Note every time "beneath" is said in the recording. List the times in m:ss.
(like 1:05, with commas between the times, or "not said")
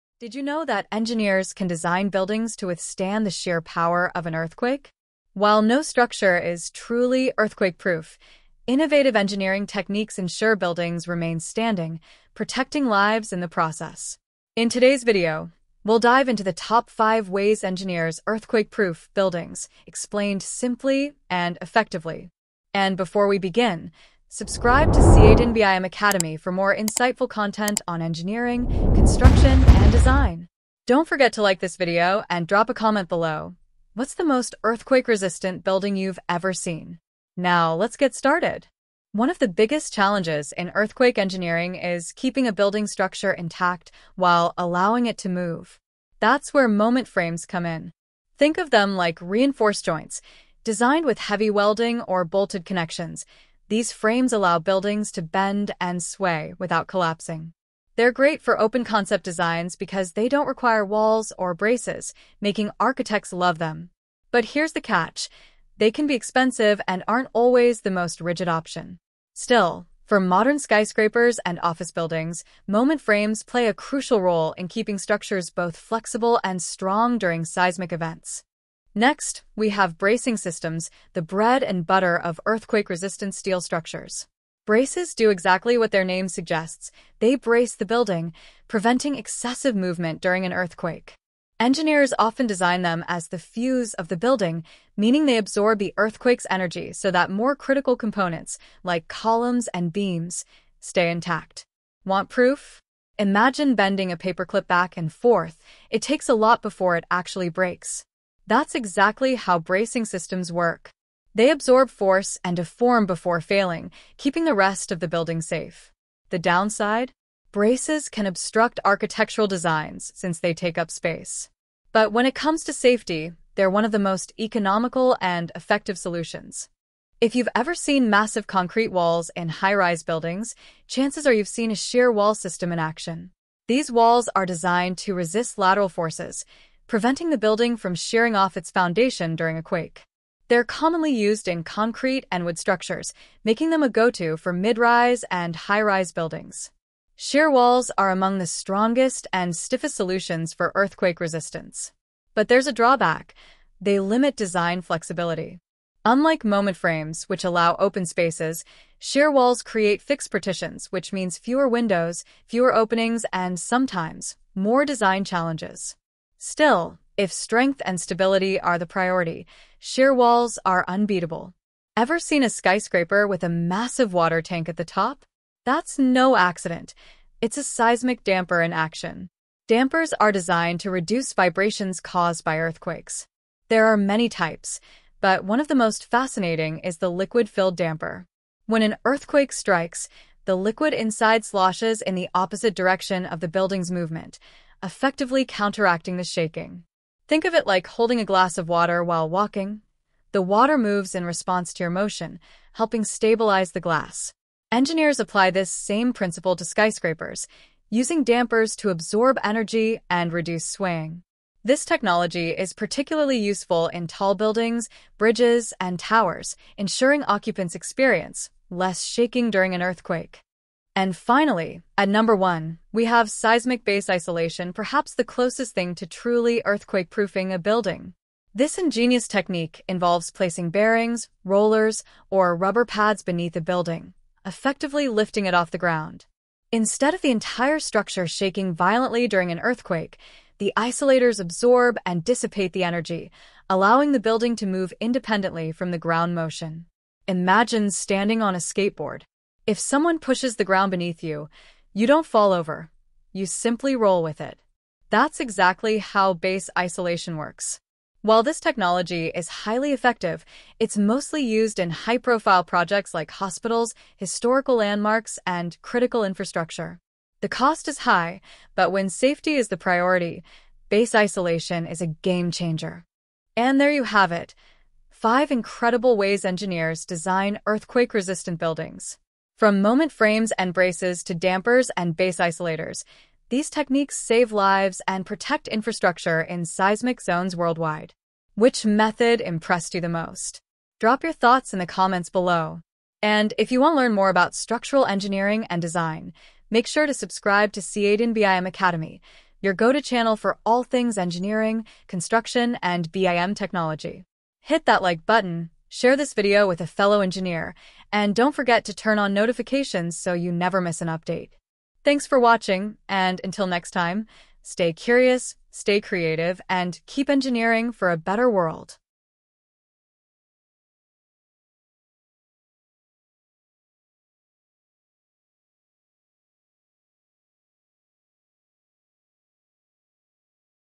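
3:53, 4:10.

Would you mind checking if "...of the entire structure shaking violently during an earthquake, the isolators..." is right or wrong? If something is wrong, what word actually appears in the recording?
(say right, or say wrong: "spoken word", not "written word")
right.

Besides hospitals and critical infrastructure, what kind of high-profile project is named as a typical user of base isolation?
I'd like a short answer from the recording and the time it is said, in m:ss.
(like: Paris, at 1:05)
historical landmarks, at 4:24.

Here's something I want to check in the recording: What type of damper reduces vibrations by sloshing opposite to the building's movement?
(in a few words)
liquid-filled damper.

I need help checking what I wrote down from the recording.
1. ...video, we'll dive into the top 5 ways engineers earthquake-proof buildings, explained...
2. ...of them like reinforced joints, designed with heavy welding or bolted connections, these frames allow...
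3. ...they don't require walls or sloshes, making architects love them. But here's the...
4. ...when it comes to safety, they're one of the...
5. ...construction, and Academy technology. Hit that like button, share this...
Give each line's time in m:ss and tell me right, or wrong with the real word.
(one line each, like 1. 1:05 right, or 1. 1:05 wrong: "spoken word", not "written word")
1. 0:15 right
2. 0:48 right
3. 1:00 wrong: "braces", not "sloshes"
4. 2:02 right
5. 5:02 wrong: "BIM", not "Academy".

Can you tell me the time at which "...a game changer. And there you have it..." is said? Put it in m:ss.
4:32.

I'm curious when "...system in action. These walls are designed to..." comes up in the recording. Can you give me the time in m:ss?
2:12.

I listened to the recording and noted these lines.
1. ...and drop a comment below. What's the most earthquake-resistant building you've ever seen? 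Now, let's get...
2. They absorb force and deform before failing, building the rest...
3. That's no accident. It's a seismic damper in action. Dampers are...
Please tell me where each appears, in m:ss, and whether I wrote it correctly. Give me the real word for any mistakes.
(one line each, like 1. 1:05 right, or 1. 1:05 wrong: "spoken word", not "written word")
1. 0:32 right
2. 1:51 wrong: "keeping", not "building"
3. 2:55 right.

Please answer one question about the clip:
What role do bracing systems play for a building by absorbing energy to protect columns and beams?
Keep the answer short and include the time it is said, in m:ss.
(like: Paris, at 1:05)
the fuse, at 1:33.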